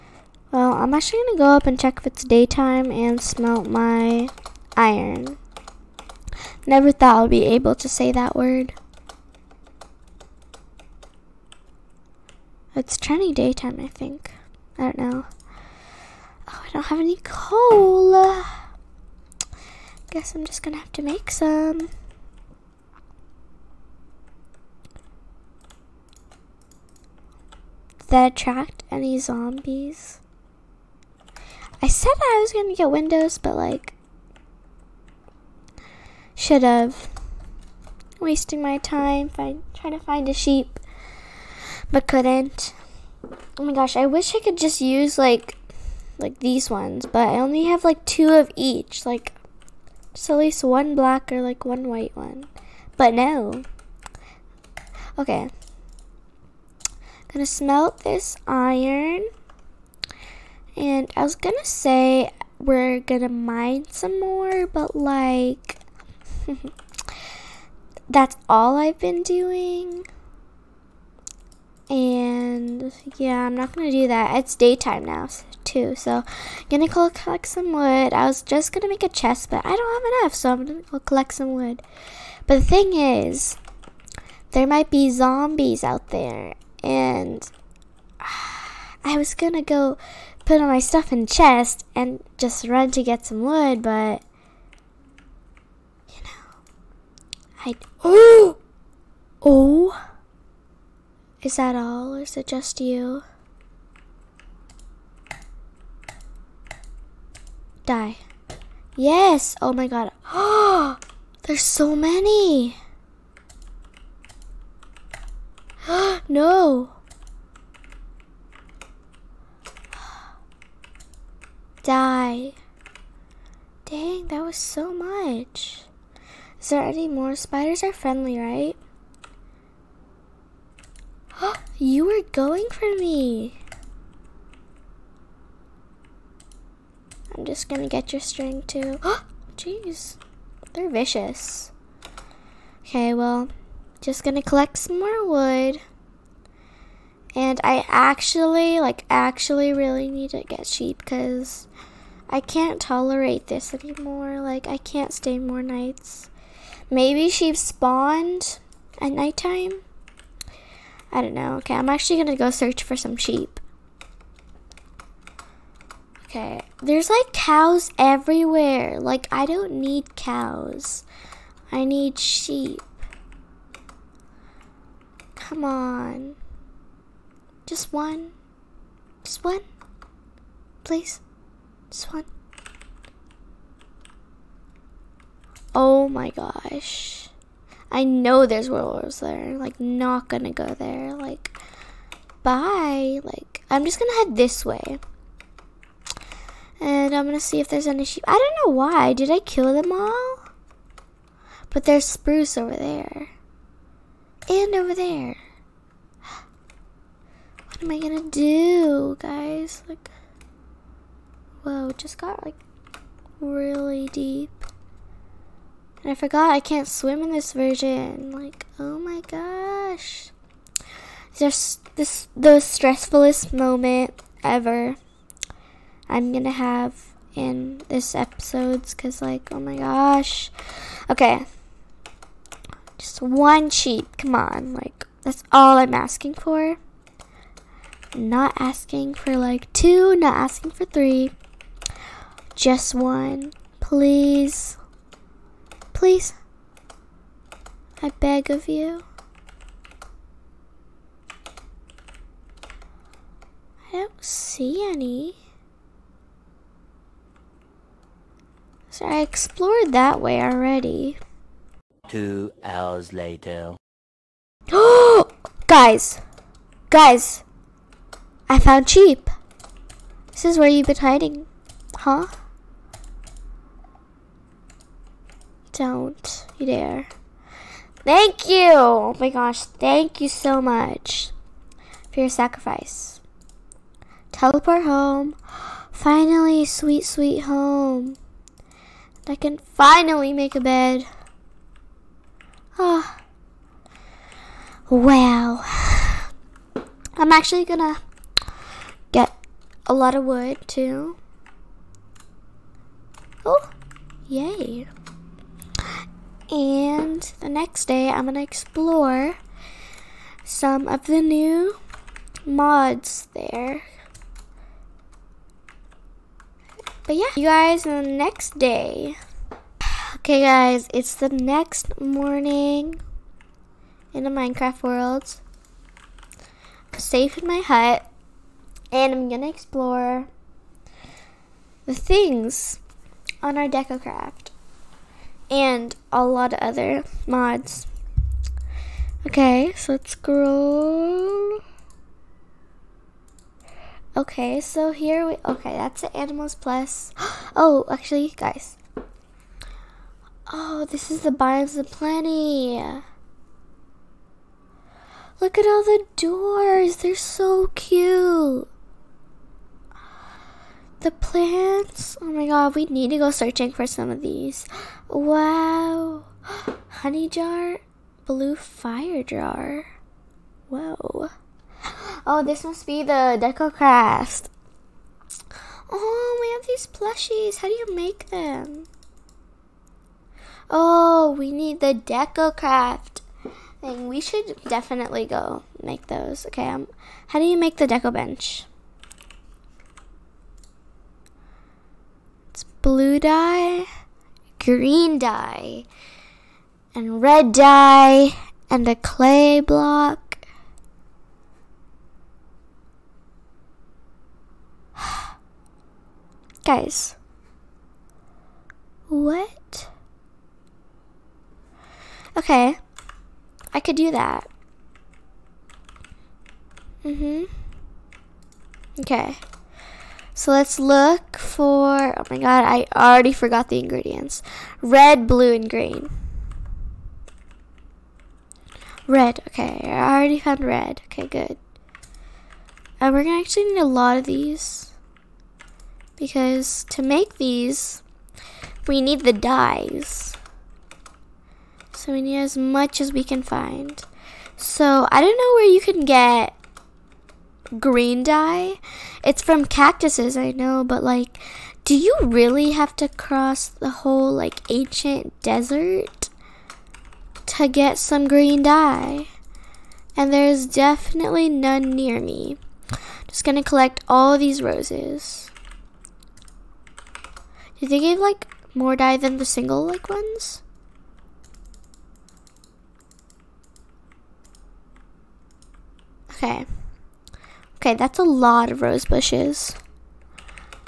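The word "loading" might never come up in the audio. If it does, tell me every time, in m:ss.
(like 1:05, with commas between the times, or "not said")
not said.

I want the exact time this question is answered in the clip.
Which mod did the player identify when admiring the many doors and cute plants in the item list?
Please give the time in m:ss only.
5:51.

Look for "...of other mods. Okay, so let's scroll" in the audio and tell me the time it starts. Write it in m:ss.
5:36.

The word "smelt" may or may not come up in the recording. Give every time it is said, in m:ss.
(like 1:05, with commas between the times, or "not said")
0:03, 0:57.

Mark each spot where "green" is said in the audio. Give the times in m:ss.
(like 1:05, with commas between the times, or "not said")
6:34, 7:05, 7:27, 7:38.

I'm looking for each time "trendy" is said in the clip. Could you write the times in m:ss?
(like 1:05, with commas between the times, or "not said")
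0:12.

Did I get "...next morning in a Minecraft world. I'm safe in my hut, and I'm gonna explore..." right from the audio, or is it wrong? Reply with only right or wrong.
right.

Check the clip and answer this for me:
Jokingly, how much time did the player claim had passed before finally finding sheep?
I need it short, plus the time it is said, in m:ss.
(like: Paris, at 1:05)
Two hours, at 4:22.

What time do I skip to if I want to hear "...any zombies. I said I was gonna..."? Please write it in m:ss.
0:28.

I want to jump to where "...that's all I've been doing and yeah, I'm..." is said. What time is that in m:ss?
1:08.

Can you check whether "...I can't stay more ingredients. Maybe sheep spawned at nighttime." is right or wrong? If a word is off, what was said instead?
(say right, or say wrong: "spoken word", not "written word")
wrong: "nights", not "ingredients".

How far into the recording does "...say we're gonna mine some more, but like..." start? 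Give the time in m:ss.
1:01.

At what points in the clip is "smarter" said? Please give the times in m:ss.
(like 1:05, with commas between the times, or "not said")
not said.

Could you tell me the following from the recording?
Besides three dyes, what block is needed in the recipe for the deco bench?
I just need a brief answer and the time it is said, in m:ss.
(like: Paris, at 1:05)
Clay block, at 6:38.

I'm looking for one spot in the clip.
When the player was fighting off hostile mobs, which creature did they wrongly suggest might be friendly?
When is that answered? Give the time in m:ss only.
2:07.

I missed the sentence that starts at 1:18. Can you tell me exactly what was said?
I was just gonna make a chest, but I don't have enough, so I'm gonna go collect some wood.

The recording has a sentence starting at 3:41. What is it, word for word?
Just this the stressfulest moment ever I'm gonna have in this episodes cause like oh my gosh.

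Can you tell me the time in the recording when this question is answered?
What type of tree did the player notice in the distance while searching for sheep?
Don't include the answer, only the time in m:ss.
3:22.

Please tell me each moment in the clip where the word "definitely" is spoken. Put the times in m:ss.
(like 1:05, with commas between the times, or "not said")
6:24, 7:40.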